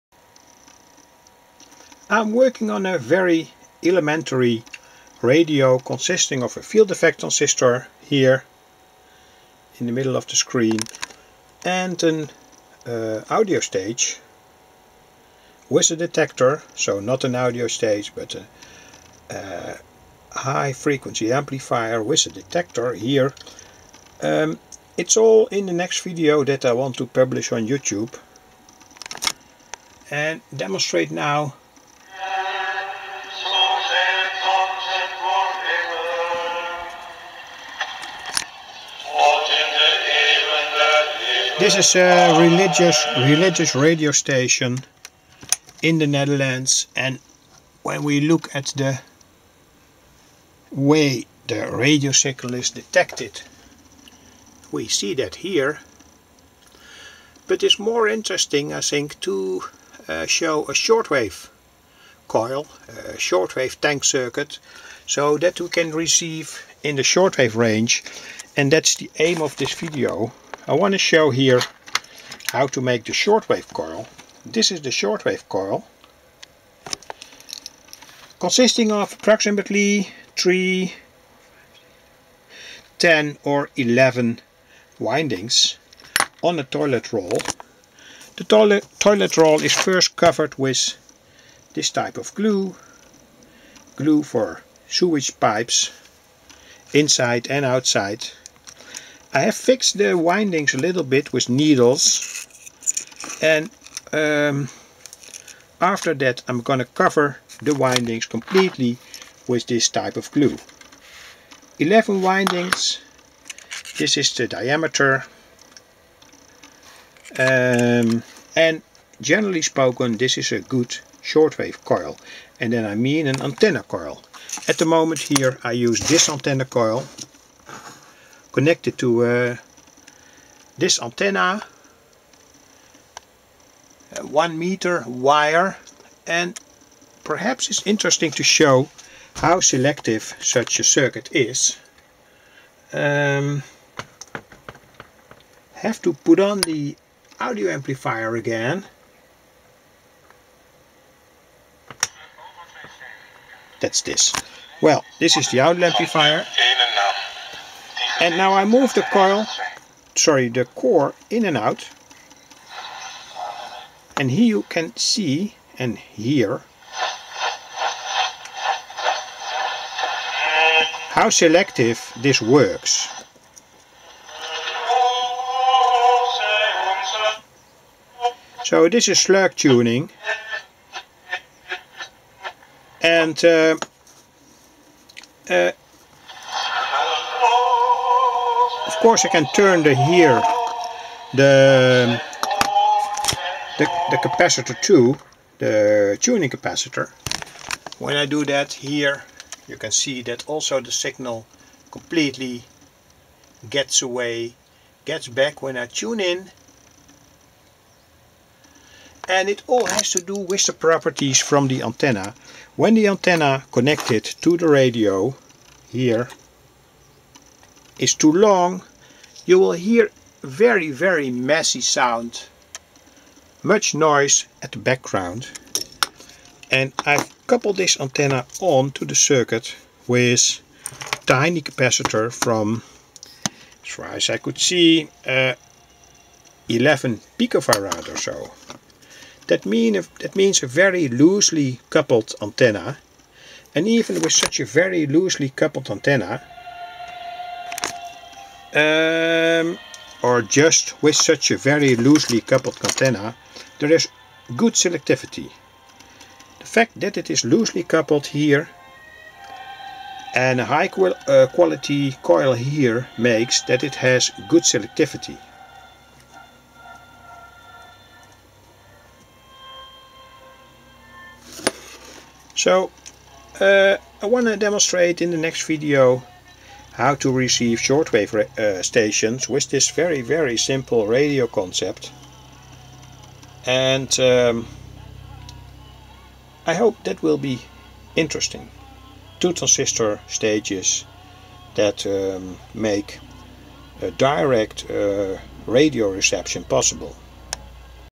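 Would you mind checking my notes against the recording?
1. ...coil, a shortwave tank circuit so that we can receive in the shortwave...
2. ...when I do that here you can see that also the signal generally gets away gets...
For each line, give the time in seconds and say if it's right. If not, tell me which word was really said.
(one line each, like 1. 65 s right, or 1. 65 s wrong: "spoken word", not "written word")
1. 62 s right
2. 197 s wrong: "completely", not "generally".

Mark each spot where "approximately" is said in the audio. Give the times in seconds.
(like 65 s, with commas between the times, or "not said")
79 s.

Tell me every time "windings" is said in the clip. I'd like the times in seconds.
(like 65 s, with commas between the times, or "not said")
84 s, 100 s, 107 s, 112 s.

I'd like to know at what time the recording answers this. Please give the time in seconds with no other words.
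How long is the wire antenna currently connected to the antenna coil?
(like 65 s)
134 s.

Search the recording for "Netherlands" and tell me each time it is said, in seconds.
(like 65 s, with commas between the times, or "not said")
46 s.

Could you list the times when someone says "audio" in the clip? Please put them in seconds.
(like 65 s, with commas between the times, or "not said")
13 s, 17 s, 147 s, 155 s.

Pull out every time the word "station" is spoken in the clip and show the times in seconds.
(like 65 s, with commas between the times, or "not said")
44 s, 278 s.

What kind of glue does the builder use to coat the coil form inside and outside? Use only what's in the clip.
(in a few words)
glue for sewage pipes.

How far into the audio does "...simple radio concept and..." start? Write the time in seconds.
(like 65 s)
280 s.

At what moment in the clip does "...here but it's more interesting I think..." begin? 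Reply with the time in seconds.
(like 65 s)
55 s.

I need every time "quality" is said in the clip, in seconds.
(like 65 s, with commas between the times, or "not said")
261 s.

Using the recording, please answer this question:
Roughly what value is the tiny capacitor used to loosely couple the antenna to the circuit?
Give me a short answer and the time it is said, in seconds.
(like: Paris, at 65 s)
11 picofarad, at 236 s.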